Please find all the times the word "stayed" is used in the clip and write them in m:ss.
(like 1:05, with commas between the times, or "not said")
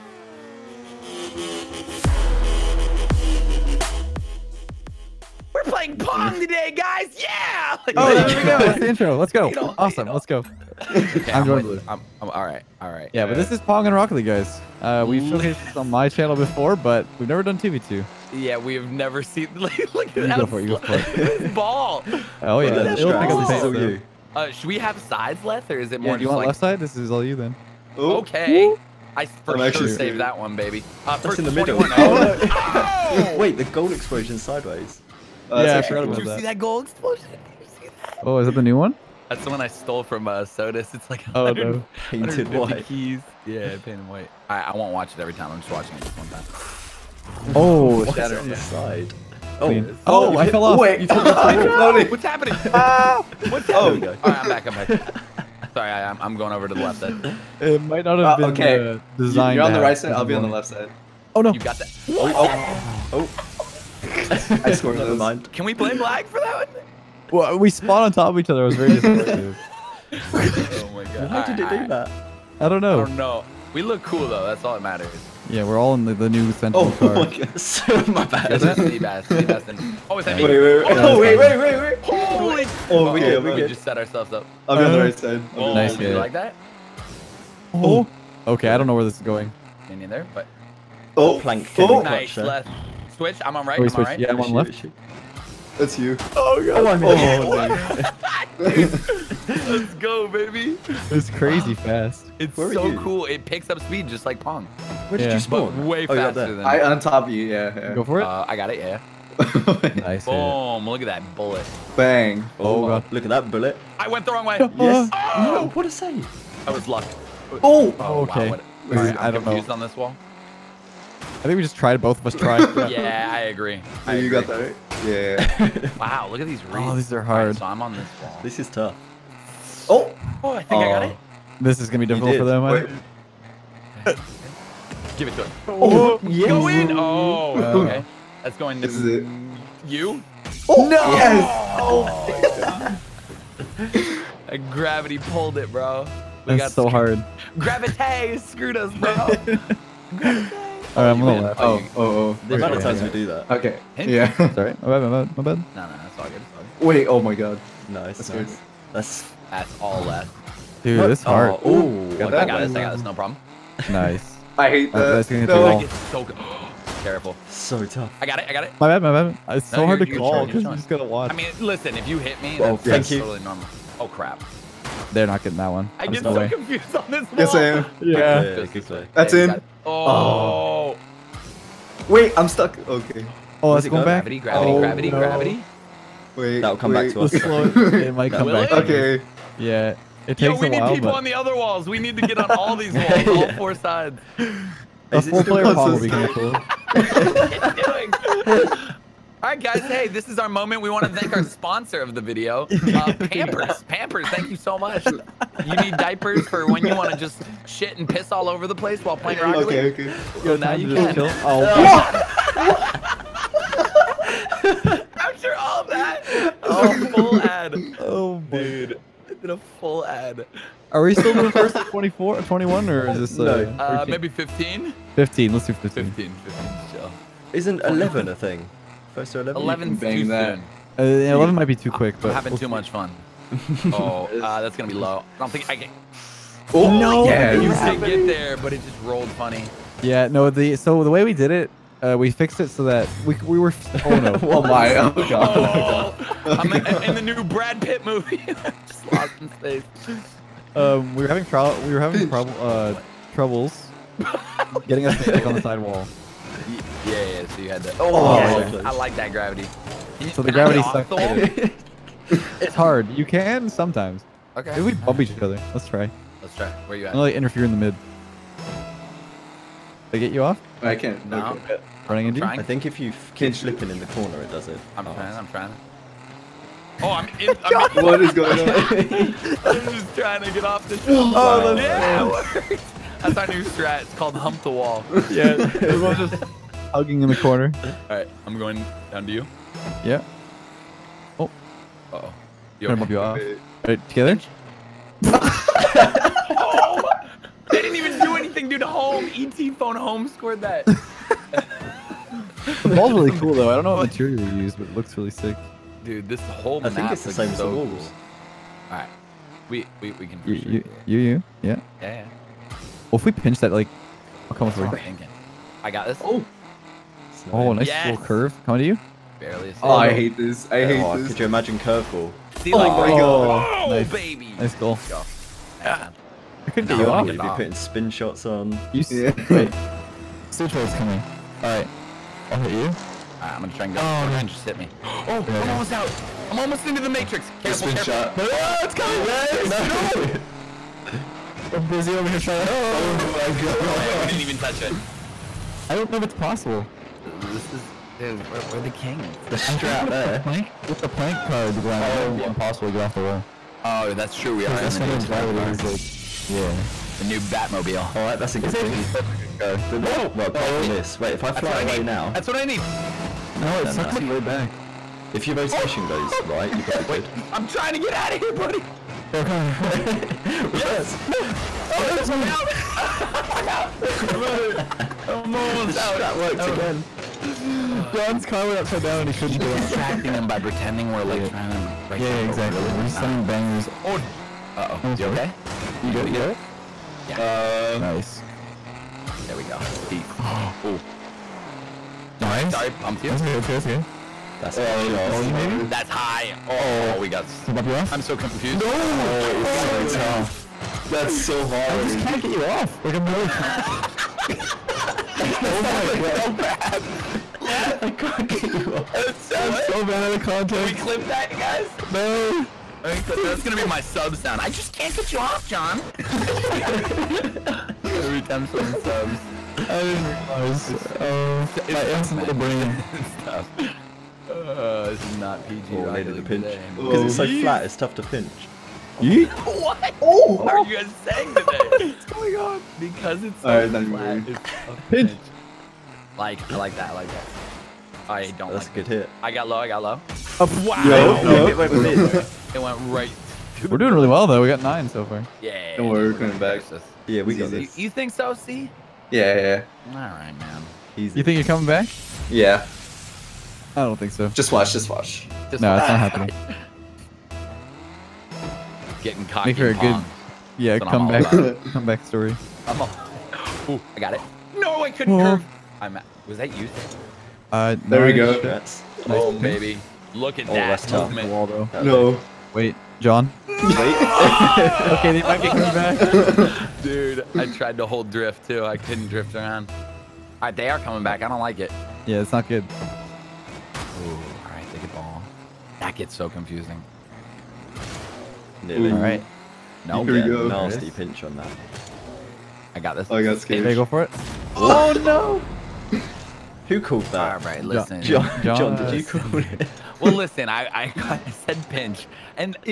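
not said.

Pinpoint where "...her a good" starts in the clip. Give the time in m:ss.
7:39.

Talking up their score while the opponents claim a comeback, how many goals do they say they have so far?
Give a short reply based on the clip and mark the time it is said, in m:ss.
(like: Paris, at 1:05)
9, at 7:24.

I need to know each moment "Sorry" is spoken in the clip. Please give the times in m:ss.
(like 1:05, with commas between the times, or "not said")
0:55, 2:34, 6:32.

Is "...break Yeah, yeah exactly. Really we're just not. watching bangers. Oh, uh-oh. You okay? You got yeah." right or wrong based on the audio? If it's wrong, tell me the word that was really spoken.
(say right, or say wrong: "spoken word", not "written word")
wrong: "sending", not "watching".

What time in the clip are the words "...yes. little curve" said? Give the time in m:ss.
5:17.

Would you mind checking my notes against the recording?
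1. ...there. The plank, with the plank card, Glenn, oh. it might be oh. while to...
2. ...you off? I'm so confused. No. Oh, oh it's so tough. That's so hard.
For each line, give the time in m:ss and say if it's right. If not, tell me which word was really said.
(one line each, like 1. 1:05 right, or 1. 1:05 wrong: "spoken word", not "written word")
1. 5:50 wrong: "impossible", not "while"
2. 6:37 right.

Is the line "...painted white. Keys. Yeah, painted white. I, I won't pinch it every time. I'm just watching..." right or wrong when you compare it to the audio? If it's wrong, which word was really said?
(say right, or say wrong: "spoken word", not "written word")
wrong: "watch", not "pinch".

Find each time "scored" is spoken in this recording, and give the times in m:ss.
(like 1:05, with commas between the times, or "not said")
1:04, 5:00.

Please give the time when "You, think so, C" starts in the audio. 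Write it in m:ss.
7:27.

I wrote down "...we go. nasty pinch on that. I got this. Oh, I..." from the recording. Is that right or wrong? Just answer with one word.
right.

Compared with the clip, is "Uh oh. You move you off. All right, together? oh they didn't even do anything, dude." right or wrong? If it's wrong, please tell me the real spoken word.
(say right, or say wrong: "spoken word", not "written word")
right.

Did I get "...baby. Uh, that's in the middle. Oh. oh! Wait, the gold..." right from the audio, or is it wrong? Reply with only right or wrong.
right.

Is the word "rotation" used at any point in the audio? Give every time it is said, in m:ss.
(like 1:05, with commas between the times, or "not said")
6:05.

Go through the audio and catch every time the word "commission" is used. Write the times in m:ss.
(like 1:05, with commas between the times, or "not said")
not said.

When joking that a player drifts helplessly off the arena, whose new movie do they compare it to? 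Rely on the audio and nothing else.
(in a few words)
Brad Pitt.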